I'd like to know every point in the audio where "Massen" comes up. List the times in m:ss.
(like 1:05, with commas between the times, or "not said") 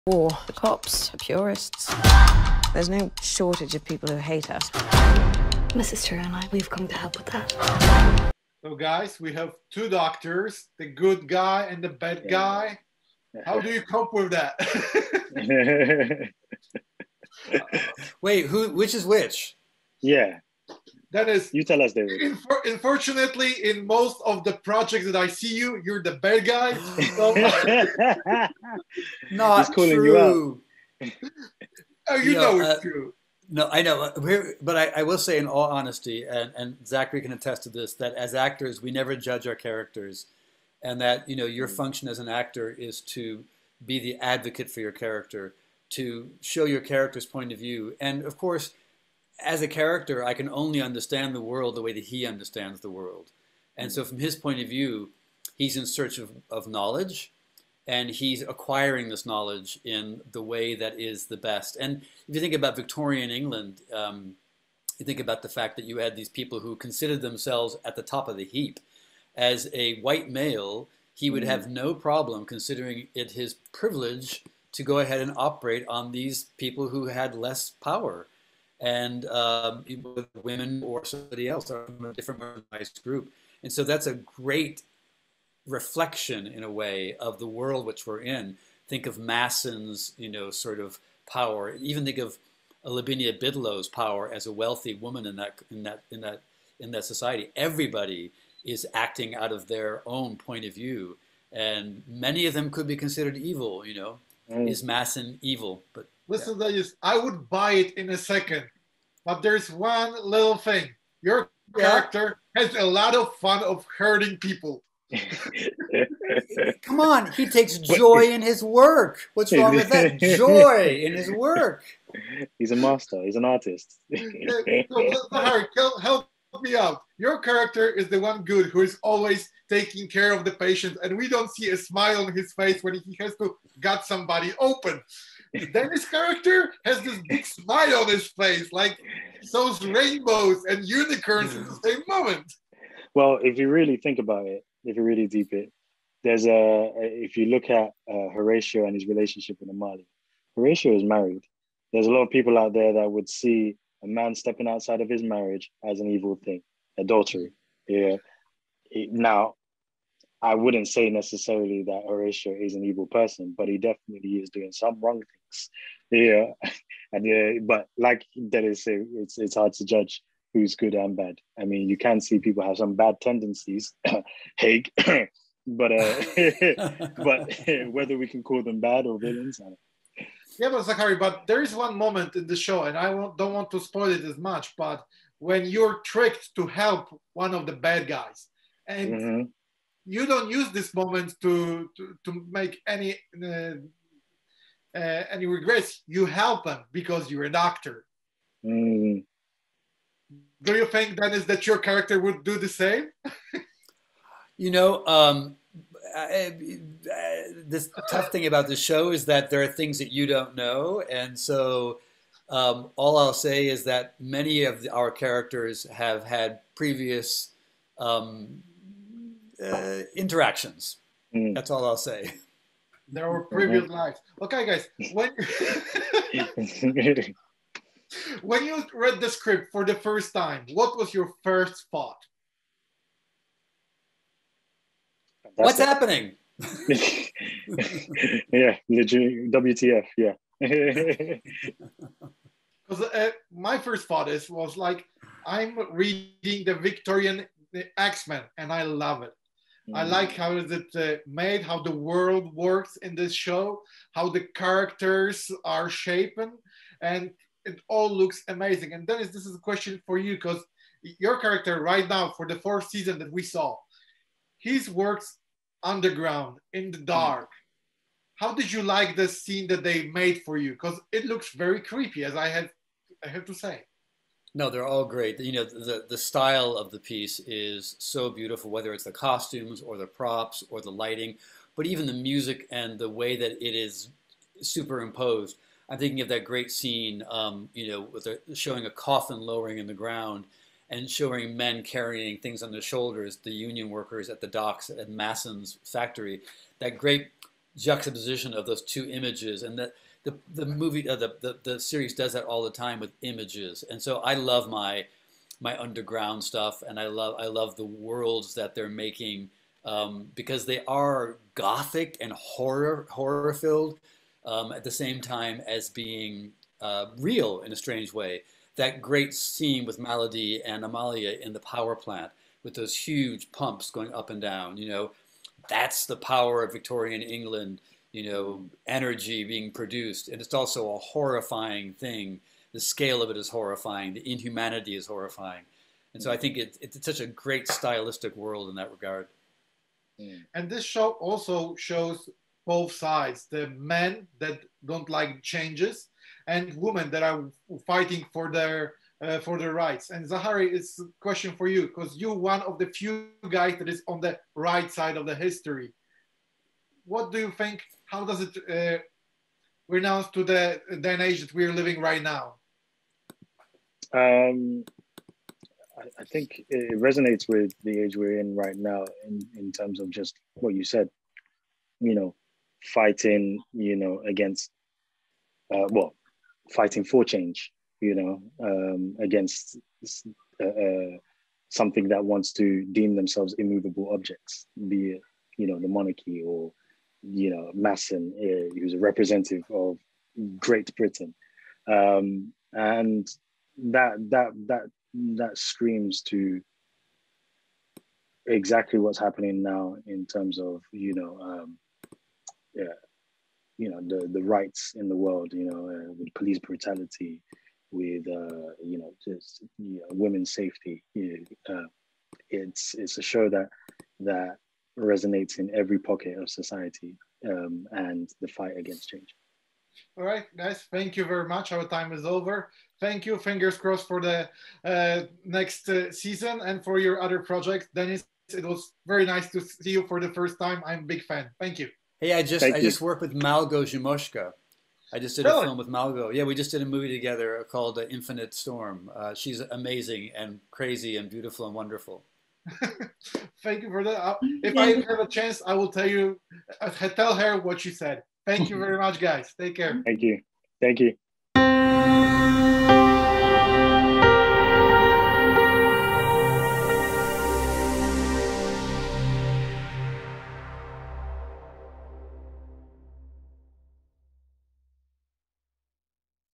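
1:29, 1:44, 4:55, 6:27.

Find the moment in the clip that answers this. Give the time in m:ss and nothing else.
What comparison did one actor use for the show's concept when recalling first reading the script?
4:06.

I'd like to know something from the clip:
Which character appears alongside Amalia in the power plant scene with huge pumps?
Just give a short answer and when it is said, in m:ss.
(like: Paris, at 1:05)
Maladie, at 5:19.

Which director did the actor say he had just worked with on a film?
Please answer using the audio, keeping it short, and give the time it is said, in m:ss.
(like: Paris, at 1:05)
Malgo Szumowska, at 7:13.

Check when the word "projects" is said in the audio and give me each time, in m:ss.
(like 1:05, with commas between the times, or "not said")
0:24, 7:07.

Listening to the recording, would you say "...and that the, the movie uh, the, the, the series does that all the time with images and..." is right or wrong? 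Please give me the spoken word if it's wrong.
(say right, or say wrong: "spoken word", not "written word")
right.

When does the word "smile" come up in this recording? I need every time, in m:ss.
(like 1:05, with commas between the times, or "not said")
2:11, 2:17.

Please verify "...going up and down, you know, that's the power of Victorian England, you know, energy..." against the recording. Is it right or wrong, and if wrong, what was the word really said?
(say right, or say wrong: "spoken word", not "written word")
right.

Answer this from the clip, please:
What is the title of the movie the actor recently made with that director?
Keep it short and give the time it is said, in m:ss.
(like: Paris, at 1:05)
Infinite Storm, at 7:18.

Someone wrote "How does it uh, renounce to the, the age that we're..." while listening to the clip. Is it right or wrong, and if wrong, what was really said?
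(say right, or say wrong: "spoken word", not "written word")
right.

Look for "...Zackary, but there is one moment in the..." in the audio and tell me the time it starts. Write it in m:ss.
3:00.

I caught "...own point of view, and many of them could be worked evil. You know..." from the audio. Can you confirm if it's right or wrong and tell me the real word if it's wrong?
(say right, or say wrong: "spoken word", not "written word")
wrong: "considered", not "worked".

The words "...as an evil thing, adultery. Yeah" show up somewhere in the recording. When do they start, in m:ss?
2:35.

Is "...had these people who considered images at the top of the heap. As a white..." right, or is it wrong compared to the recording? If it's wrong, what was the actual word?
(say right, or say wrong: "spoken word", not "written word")
wrong: "themselves", not "images".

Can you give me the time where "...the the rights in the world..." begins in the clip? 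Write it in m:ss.
6:44.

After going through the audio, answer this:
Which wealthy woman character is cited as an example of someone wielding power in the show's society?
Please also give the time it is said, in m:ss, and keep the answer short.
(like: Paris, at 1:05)
Lavinia Bidlow, at 1:32.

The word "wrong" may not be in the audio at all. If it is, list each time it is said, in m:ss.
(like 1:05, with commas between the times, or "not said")
1:59, 2:45.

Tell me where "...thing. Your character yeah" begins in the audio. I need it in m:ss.
1:50.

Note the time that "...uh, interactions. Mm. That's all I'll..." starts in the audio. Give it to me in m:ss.
3:39.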